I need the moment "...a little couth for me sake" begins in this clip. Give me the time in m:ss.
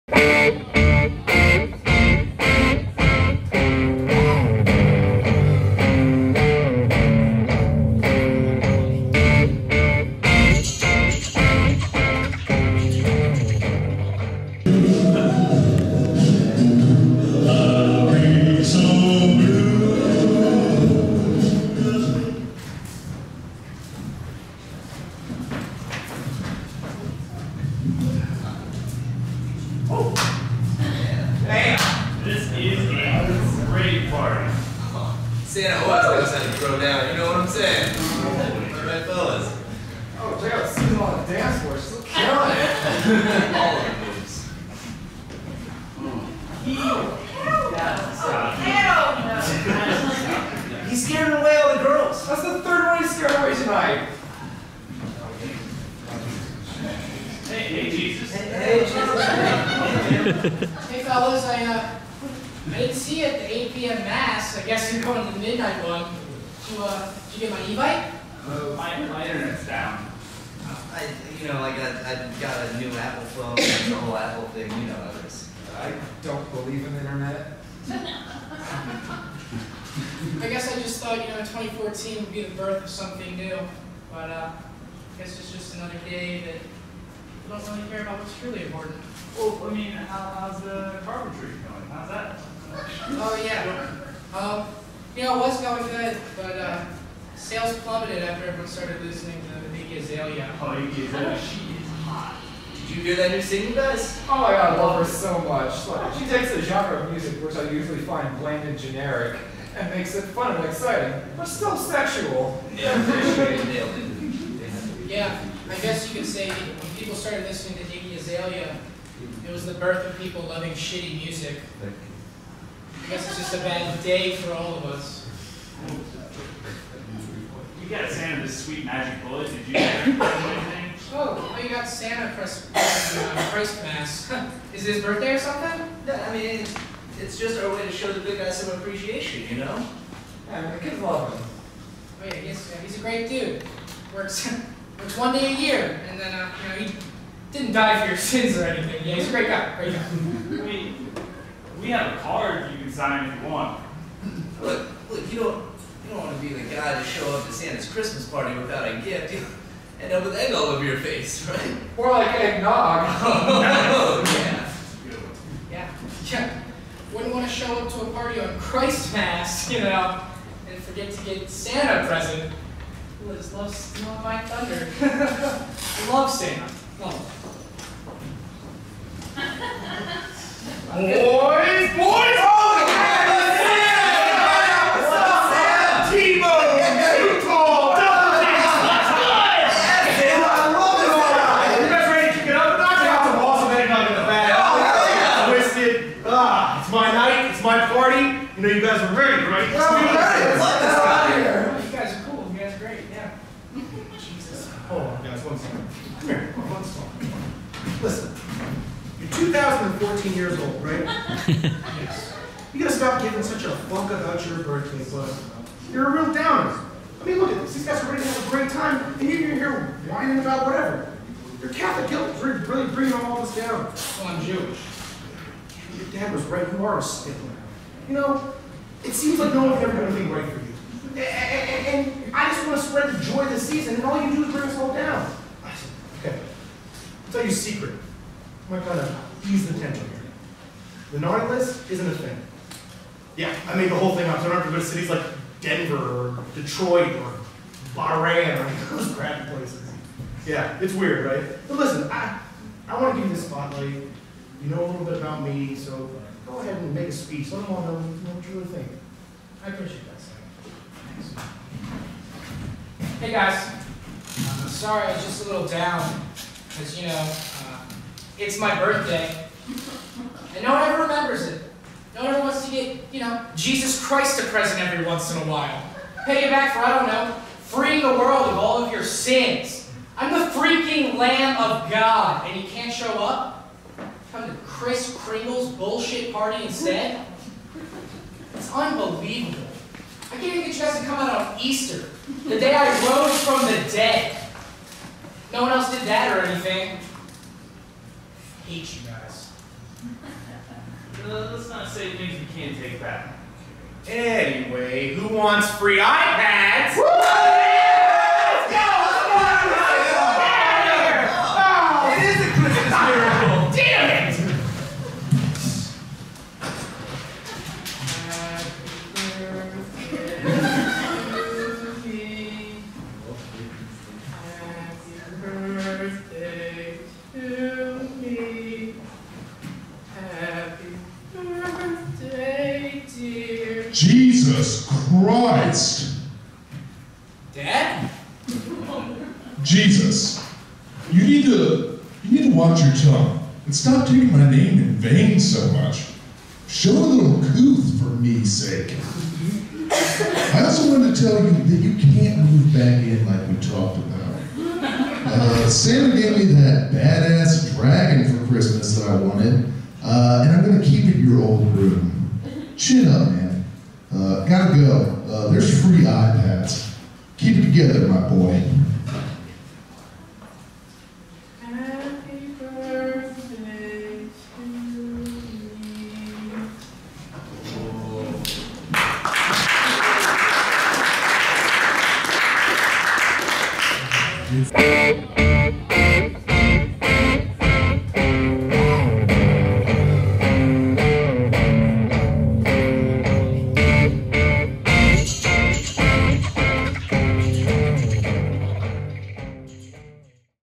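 5:46.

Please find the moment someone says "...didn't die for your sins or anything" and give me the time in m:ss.
2:27.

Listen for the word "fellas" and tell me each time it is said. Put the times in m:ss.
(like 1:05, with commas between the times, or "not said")
0:39, 1:01.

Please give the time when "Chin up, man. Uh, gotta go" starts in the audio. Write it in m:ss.
6:02.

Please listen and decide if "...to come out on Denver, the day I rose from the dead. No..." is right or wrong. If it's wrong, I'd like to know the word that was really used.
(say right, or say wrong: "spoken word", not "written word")
wrong: "Easter", not "Denver".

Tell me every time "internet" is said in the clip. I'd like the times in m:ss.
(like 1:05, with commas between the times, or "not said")
1:09, 1:17.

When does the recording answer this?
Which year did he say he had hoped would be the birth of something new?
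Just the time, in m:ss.
1:21.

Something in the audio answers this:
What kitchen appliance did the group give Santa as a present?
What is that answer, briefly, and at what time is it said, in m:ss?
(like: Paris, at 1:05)
magic bullet, at 2:08.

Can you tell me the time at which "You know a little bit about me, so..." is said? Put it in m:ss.
4:13.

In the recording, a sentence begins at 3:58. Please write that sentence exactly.
I'm to ease the tension here.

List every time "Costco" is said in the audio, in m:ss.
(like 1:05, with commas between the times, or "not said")
not said.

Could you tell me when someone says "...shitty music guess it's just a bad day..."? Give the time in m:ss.
2:00.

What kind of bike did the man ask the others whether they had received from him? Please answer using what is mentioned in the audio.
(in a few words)
e-bike.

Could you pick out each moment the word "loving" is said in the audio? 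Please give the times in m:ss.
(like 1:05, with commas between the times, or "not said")
2:00.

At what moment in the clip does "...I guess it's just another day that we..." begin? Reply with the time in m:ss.
1:24.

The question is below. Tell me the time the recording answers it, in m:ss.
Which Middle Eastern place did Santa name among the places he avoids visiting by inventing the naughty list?
4:07.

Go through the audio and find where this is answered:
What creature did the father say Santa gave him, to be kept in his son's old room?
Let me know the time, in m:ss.
5:57.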